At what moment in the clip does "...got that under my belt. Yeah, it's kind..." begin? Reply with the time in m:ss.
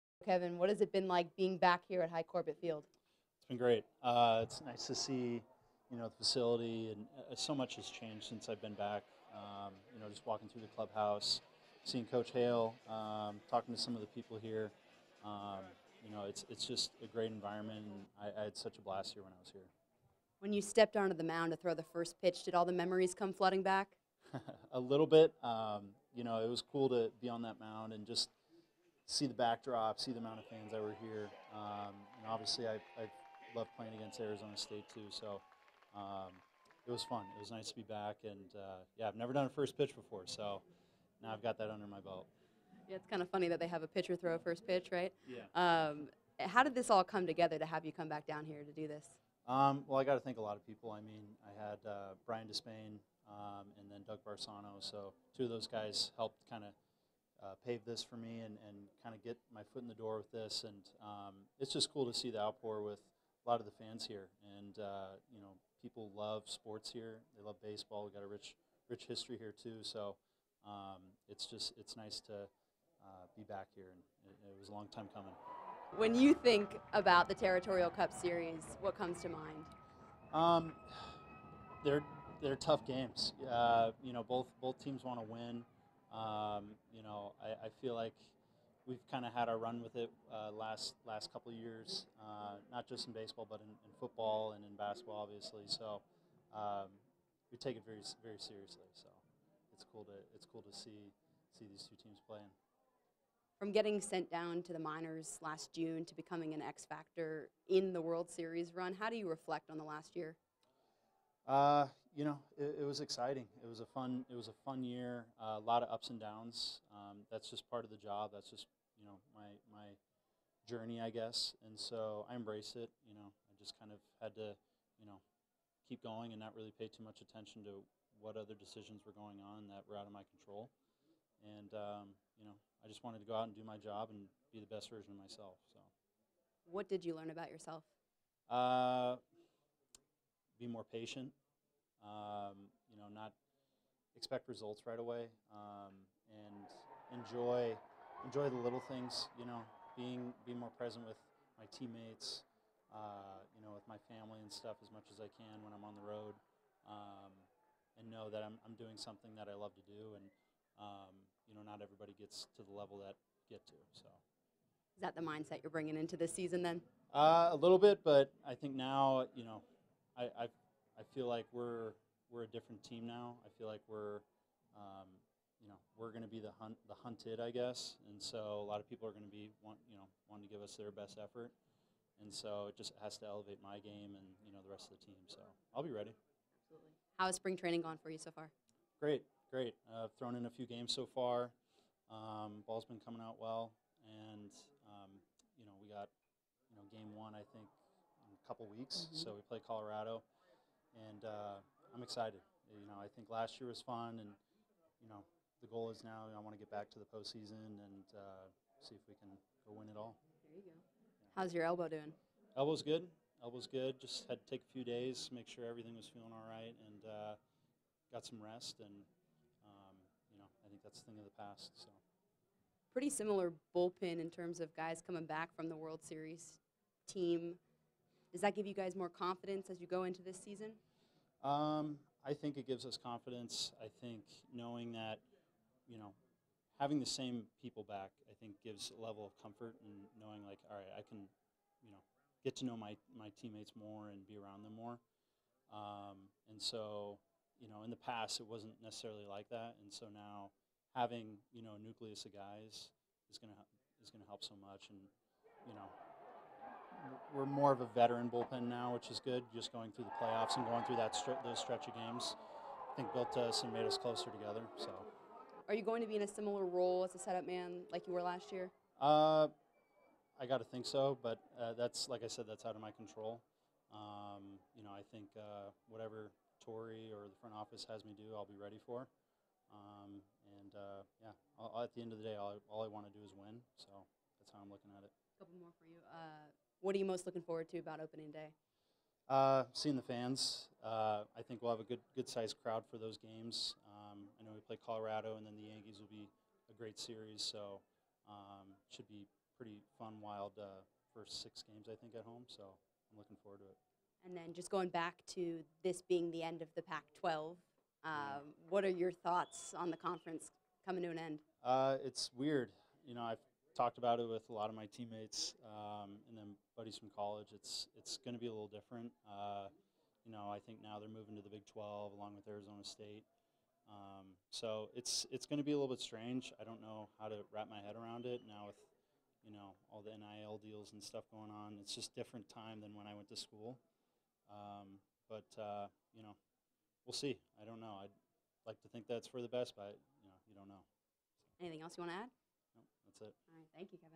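0:41.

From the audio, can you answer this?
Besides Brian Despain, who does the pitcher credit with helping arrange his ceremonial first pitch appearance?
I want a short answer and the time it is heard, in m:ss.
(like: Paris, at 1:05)
Doug Barsano, at 0:54.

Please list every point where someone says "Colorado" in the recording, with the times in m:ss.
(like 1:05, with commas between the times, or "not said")
3:19, 4:54.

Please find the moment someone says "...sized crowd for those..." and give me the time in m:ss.
4:52.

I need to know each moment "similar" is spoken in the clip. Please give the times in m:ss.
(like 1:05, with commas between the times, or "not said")
3:43, 4:26.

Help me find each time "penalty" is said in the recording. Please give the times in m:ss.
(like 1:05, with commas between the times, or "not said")
not said.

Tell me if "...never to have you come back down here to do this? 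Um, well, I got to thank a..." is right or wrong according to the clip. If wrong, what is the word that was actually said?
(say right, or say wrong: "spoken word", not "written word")
wrong: "together", not "never".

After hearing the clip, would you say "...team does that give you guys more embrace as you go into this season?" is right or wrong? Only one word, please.
wrong.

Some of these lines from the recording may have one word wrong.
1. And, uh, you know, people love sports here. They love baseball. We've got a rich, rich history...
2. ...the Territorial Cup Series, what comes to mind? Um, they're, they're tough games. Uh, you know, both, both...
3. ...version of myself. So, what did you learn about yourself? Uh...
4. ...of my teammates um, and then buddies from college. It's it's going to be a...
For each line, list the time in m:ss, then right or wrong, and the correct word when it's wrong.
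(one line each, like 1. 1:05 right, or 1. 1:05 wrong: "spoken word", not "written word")
1. 1:04 right
2. 1:17 right
3. 2:14 right
4. 5:14 right.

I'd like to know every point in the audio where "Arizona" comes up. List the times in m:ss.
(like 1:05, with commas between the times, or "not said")
0:34, 5:22.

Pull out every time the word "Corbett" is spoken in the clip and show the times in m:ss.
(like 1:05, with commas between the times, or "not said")
0:02.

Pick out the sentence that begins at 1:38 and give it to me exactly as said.
So it's cool to it's cool to see see these two teams playing.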